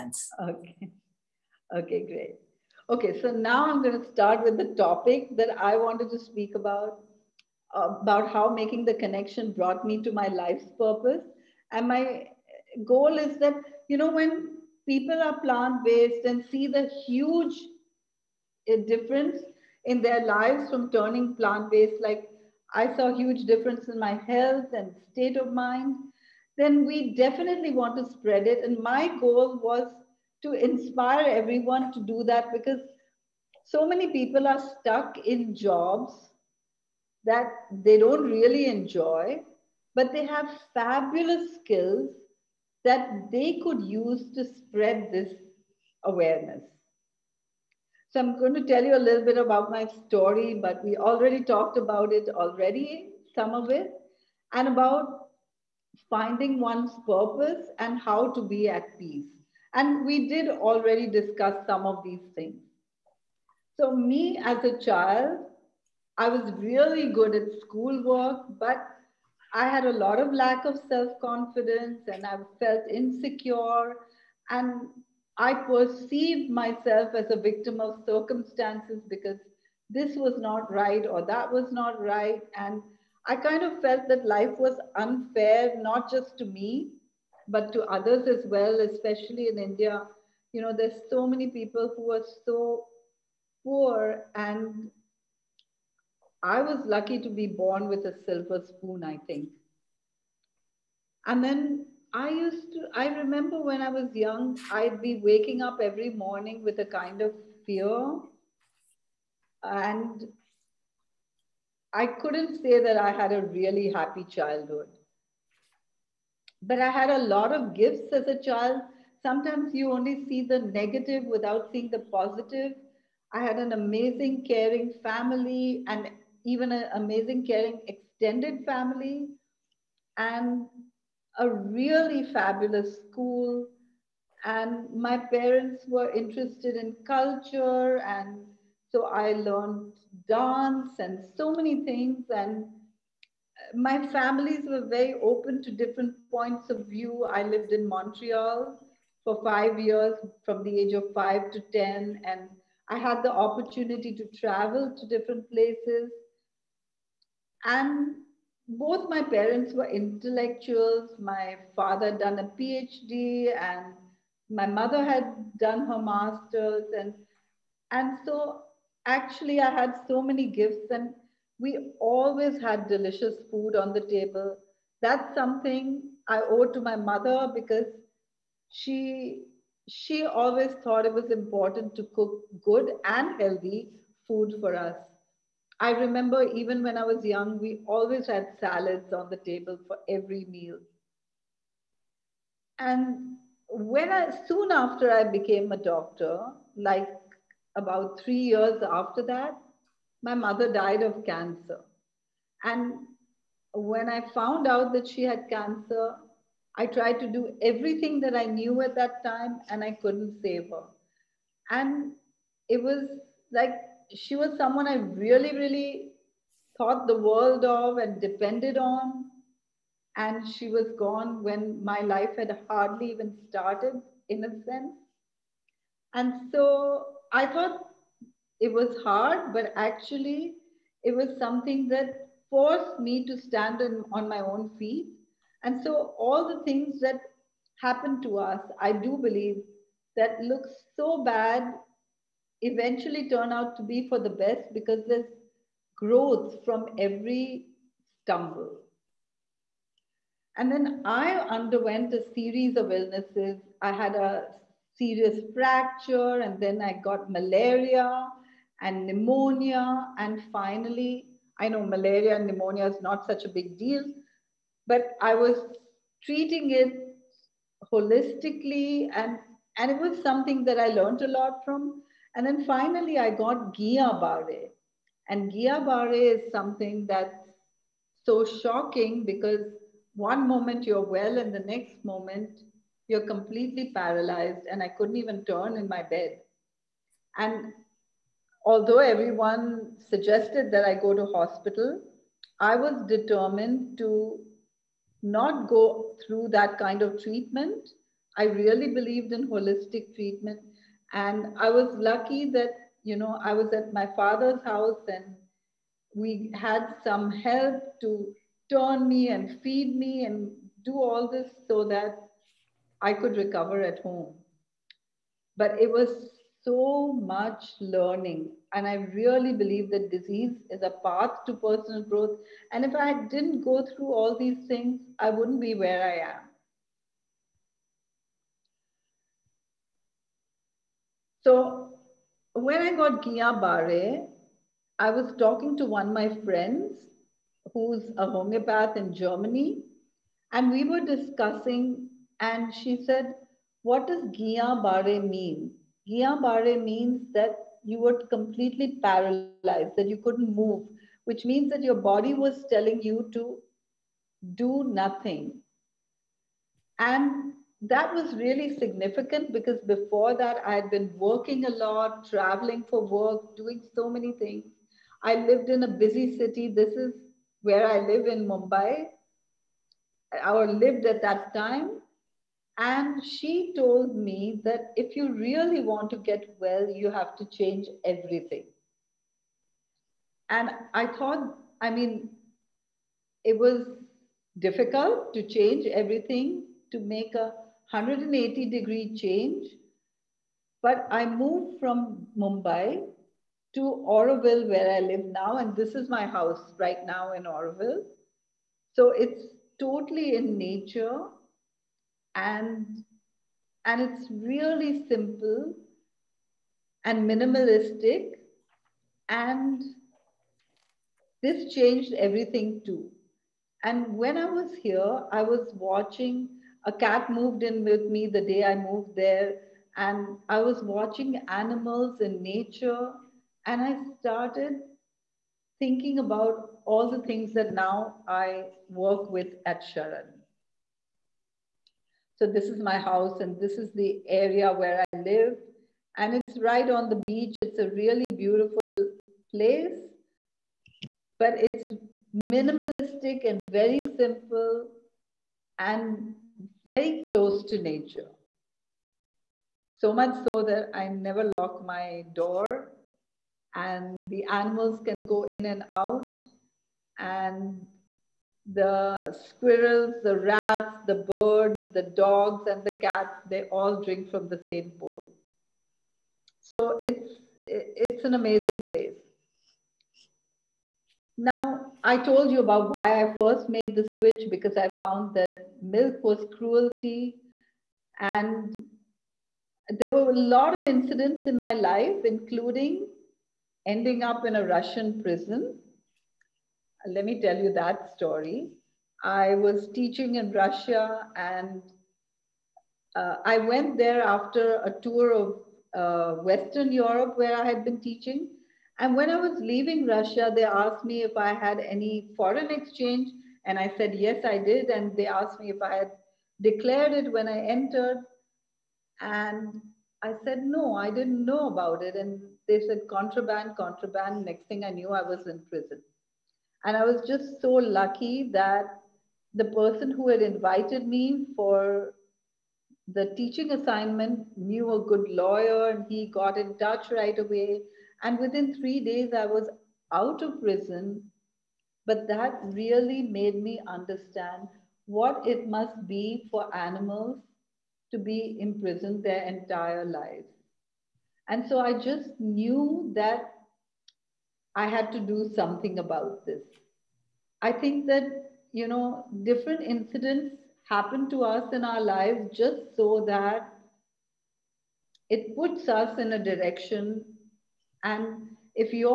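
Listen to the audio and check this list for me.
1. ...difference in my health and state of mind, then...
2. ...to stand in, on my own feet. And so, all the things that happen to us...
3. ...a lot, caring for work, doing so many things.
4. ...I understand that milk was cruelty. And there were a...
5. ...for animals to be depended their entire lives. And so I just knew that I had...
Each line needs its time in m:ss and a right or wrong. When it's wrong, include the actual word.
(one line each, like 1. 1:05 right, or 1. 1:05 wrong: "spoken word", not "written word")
1. 0:23 right
2. 3:53 right
3. 6:01 wrong: "traveling", not "caring"
4. 7:54 wrong: "found", not "understand"
5. 8:56 wrong: "imprisoned", not "depended".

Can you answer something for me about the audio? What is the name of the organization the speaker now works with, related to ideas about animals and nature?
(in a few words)
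Sharan.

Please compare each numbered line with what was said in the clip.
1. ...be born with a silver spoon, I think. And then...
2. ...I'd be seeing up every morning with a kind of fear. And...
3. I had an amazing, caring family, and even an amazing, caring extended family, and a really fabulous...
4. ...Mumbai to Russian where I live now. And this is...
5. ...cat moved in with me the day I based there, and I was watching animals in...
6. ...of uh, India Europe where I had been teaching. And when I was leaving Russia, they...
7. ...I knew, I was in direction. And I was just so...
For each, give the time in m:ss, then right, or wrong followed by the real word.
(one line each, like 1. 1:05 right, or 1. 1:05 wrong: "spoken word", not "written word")
1. 1:37 right
2. 1:44 wrong: "waking", not "seeing"
3. 2:03 right
4. 6:32 wrong: "Auroville", not "Russian"
5. 6:56 wrong: "moved", not "based"
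6. 8:15 wrong: "Western", not "India"
7. 8:34 wrong: "prison", not "direction".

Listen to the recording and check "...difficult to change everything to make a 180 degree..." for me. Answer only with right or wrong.
right.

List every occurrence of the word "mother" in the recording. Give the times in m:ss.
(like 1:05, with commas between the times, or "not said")
2:44, 2:56, 3:20.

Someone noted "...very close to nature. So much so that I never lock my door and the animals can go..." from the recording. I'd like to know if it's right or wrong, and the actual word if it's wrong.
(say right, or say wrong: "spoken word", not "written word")
right.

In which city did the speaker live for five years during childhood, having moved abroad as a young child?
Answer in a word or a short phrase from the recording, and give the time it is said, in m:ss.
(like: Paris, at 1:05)
Montreal, at 2:27.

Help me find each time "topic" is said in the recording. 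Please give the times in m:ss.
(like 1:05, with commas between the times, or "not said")
0:04.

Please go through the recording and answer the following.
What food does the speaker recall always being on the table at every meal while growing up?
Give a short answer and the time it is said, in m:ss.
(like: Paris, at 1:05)
Salads, at 3:08.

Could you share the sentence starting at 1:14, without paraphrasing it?
And I perceived myself as a victim of circumstances because this was not right or that was not right.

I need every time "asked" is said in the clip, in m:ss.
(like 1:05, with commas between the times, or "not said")
8:20, 8:25.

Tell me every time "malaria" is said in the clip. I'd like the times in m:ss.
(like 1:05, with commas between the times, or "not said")
4:17, 4:21.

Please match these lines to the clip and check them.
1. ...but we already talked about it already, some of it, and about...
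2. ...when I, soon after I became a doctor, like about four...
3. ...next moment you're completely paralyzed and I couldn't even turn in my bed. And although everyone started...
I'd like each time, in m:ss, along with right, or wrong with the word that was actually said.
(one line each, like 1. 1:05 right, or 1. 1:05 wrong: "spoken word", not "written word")
1. 0:50 right
2. 3:13 wrong: "three", not "four"
3. 4:41 wrong: "suggested", not "started".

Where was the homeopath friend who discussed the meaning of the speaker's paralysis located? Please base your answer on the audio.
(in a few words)
Germany.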